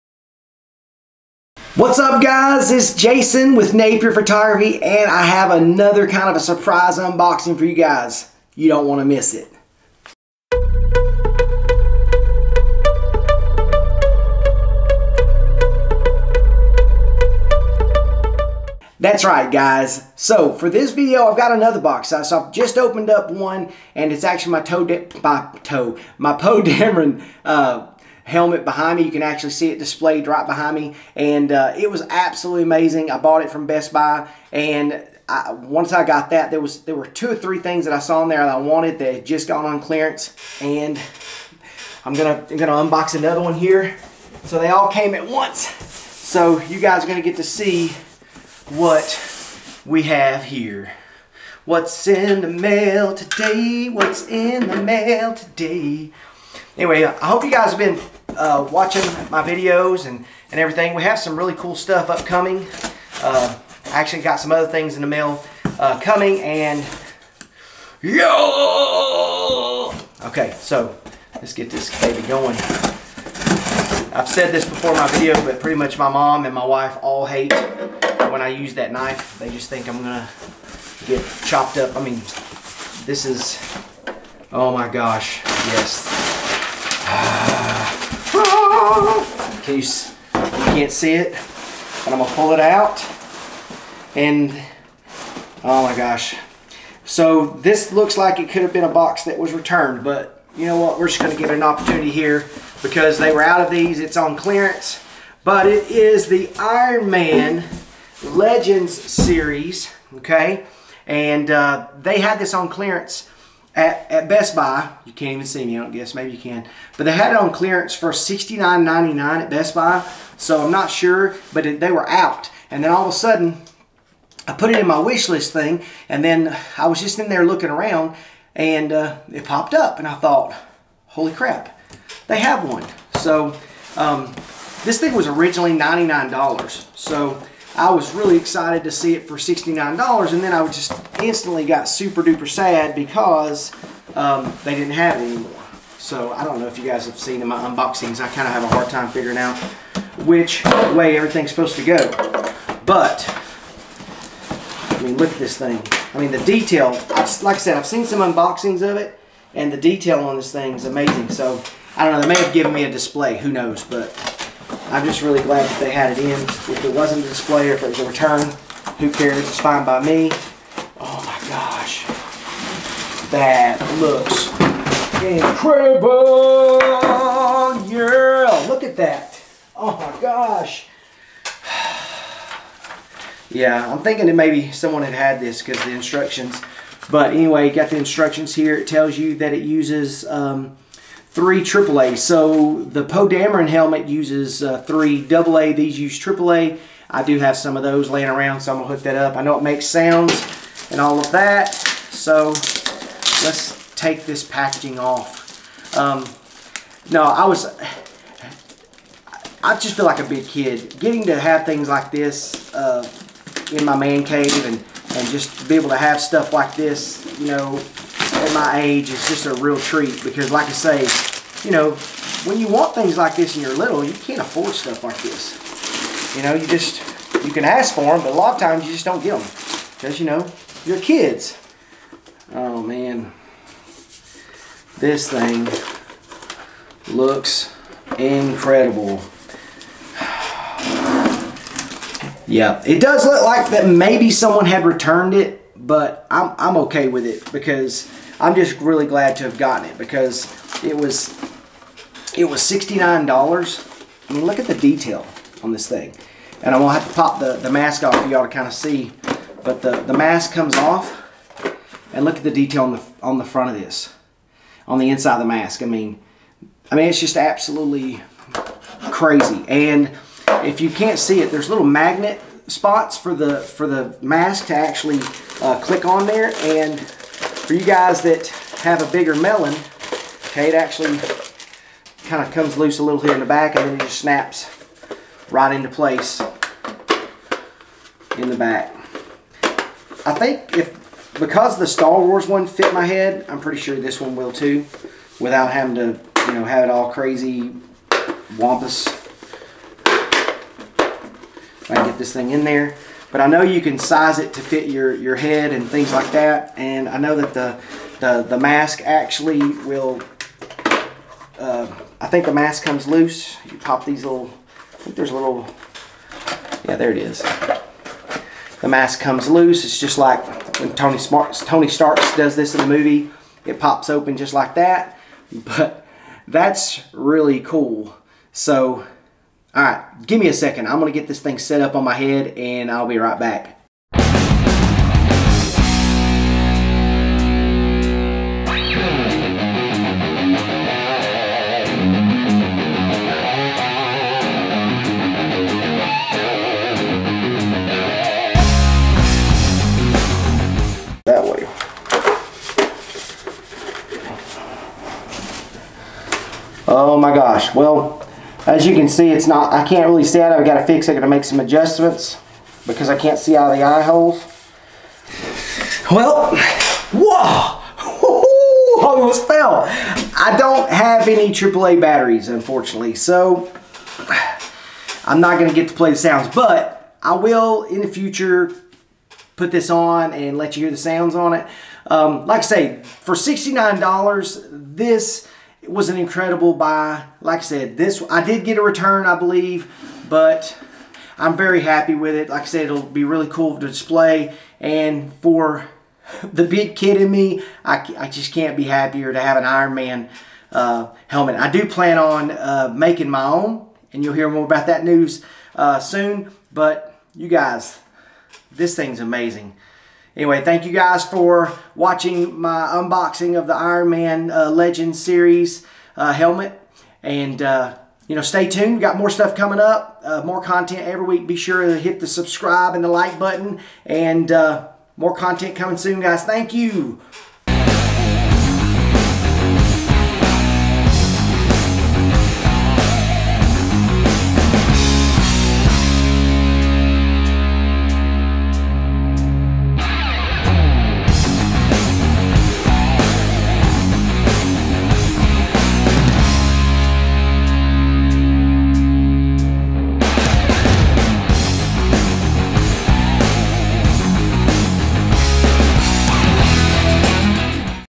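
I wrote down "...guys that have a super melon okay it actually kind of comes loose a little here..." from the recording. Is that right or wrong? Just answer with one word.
wrong.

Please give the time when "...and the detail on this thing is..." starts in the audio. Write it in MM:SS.
02:39.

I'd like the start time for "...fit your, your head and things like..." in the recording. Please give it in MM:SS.
05:04.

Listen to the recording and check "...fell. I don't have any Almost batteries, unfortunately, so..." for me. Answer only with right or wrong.
wrong.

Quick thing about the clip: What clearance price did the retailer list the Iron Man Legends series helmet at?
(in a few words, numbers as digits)
$69.99.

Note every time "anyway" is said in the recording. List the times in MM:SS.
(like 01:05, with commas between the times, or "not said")
00:56, 03:07, 06:50.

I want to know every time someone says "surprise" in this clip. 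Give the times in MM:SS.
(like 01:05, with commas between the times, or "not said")
00:06.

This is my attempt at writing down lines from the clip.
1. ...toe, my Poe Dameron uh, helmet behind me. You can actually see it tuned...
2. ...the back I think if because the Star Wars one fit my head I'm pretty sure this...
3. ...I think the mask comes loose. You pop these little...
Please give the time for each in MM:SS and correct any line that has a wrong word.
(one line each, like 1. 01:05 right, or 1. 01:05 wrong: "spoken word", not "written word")
1. 00:25 wrong: "displayed", not "tuned"
2. 04:48 right
3. 05:12 right.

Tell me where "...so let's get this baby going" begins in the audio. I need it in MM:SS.
01:10.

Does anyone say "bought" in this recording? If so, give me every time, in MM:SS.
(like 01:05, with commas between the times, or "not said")
00:33.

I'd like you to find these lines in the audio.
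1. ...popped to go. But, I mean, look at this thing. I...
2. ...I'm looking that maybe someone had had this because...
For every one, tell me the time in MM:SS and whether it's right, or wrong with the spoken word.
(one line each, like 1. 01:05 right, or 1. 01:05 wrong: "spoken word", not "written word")
1. 02:31 wrong: "supposed", not "popped"
2. 03:03 wrong: "thinking", not "looking".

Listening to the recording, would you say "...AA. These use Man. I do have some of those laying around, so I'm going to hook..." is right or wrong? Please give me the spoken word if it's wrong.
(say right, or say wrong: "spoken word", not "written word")
wrong: "AAA", not "Man".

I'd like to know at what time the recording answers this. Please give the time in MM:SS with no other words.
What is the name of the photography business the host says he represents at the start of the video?
00:03.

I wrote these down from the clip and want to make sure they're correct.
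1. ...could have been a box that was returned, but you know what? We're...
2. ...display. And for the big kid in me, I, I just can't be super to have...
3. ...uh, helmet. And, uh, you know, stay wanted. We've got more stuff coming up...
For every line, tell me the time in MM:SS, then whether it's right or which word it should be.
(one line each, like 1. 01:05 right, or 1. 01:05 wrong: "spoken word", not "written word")
1. 01:38 right
2. 06:33 wrong: "happier", not "super"
3. 06:56 wrong: "tuned", not "wanted".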